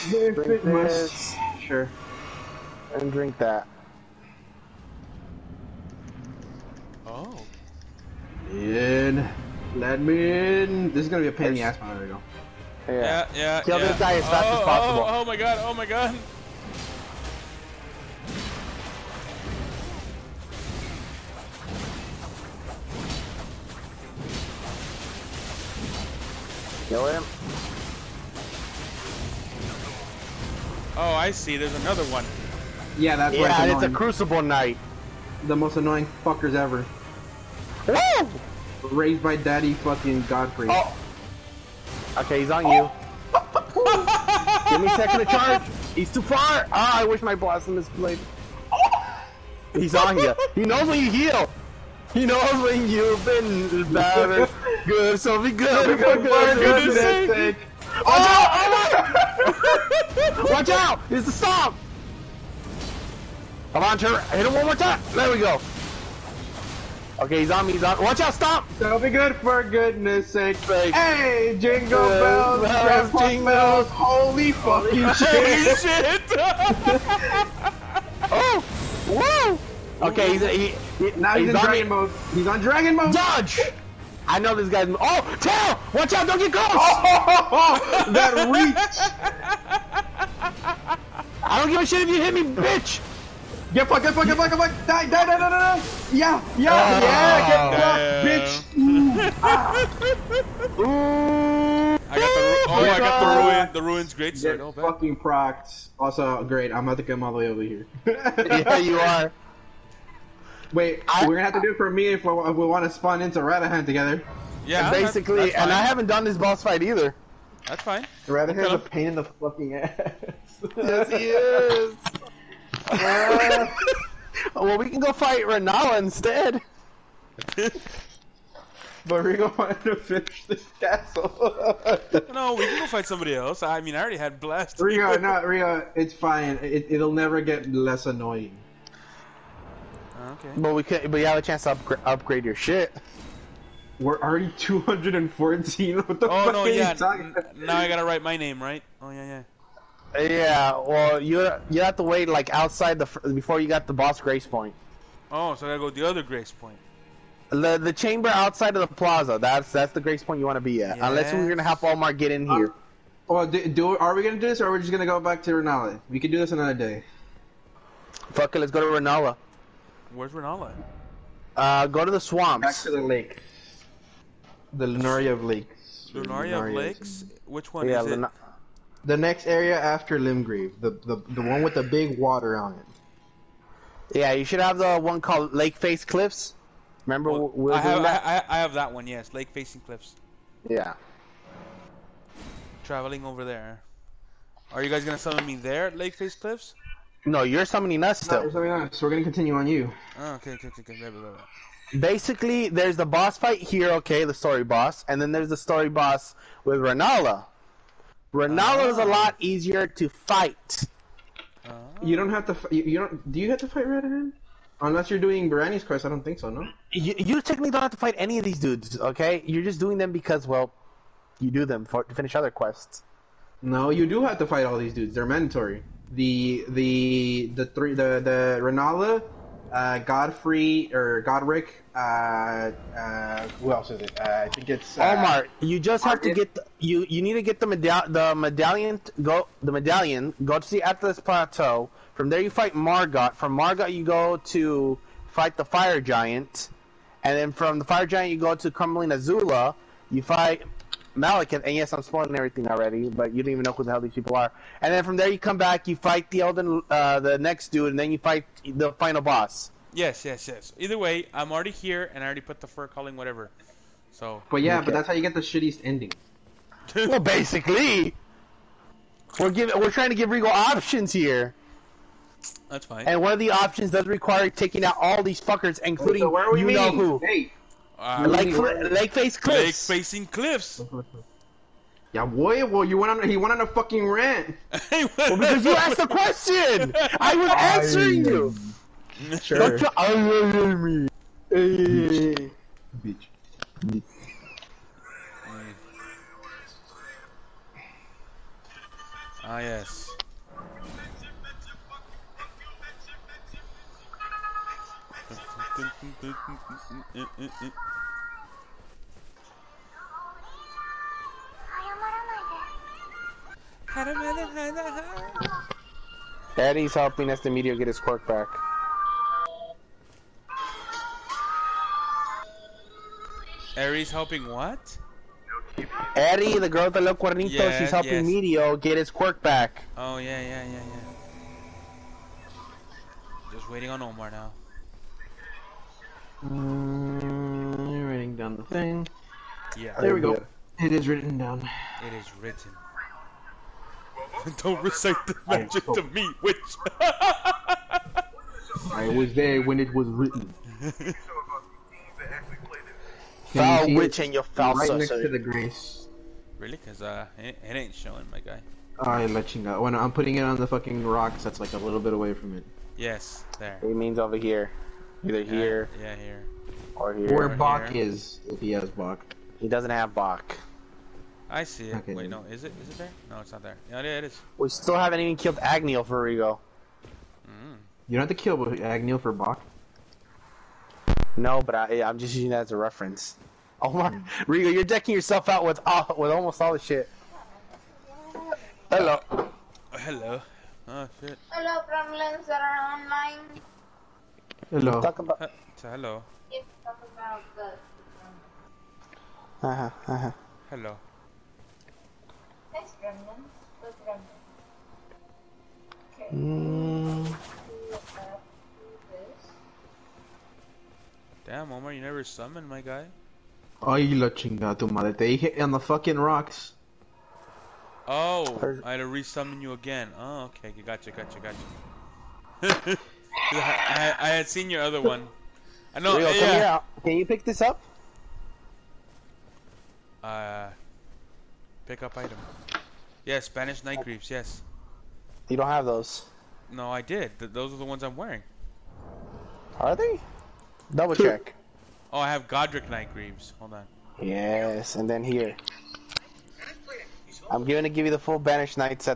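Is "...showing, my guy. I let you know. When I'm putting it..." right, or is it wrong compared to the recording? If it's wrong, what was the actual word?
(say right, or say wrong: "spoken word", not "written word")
right.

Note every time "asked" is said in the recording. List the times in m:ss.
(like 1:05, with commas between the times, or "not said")
4:45.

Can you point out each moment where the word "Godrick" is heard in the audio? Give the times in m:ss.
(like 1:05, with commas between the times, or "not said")
3:51, 7:22.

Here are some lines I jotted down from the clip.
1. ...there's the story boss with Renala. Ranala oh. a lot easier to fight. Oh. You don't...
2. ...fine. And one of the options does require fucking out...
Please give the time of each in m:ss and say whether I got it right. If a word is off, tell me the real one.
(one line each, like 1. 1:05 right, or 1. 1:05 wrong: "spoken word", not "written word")
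1. 3:25 right
2. 4:32 wrong: "taking", not "fucking".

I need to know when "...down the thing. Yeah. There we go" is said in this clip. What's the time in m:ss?
5:38.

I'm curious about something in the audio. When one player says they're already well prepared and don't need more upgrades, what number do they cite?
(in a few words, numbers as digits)
214.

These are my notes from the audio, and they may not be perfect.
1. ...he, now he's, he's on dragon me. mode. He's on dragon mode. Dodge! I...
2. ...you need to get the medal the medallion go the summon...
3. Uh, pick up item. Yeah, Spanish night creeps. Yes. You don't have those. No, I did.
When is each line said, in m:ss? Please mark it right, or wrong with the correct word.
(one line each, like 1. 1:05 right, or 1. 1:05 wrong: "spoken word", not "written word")
1. 1:21 right
2. 3:57 wrong: "medallion", not "summon"
3. 7:10 right.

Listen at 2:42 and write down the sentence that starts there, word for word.
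Uh, well, do, do, are we gonna do this, or are we just gonna go back to Renala?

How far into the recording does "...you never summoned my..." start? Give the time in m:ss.
6:51.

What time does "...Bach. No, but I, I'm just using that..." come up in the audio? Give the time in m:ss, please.
6:19.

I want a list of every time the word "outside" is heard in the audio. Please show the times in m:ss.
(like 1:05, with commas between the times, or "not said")
2:32, 2:38.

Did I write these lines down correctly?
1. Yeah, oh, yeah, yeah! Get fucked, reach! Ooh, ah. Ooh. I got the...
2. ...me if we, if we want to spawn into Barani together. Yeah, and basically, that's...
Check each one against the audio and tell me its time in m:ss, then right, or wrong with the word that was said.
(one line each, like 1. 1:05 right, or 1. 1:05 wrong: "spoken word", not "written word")
1. 1:36 wrong: "bitch", not "reach"
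2. 1:51 wrong: "Radahn", not "Barani".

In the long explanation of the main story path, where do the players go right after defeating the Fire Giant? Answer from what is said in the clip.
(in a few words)
Crumbling Azula.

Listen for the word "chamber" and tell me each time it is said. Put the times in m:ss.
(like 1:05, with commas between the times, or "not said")
2:37.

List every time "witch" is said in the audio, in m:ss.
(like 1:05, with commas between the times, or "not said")
5:46, 5:53.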